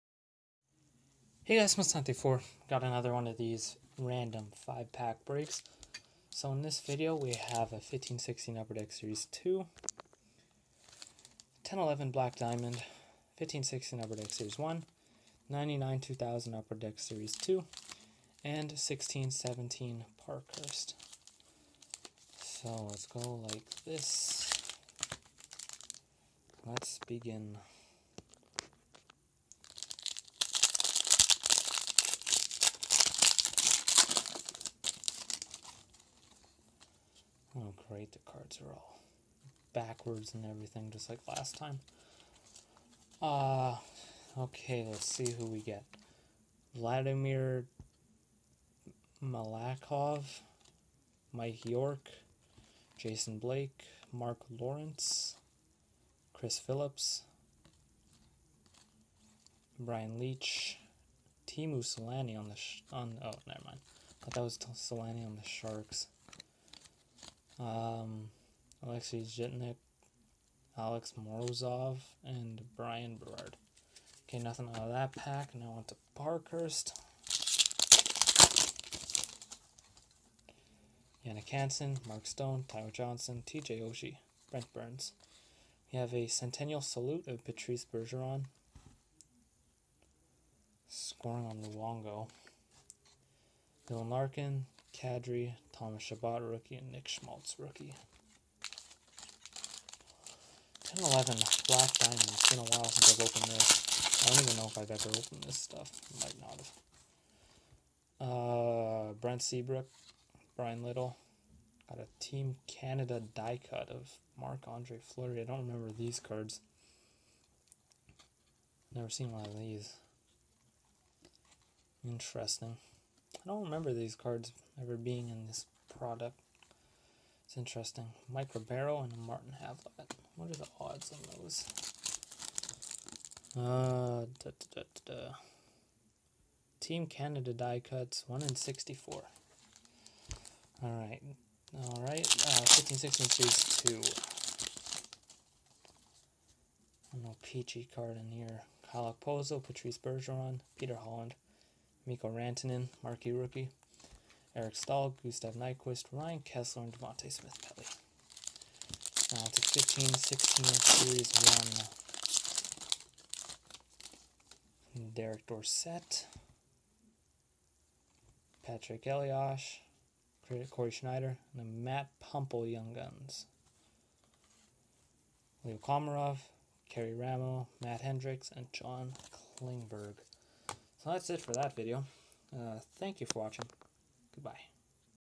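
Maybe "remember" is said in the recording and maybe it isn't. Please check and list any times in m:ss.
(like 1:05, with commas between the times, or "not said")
1:55, 2:03.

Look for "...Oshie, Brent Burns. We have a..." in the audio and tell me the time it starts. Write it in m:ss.
1:23.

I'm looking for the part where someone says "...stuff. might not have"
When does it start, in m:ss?
1:45.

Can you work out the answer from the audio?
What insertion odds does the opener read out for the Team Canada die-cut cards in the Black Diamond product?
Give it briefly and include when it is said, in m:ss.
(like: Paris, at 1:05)
1 in 64, at 2:18.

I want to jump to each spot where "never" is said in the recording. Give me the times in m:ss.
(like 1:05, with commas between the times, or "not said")
1:03, 1:58.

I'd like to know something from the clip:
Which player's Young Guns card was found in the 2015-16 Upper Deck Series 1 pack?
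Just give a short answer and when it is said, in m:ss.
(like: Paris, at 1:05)
Matt Puempel, at 2:51.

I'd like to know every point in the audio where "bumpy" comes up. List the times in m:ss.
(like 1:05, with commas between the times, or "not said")
not said.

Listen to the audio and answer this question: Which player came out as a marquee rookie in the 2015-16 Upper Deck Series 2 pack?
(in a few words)
Mikko Rantanen.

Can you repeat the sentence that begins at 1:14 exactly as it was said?
Okay, nothing out of that pack.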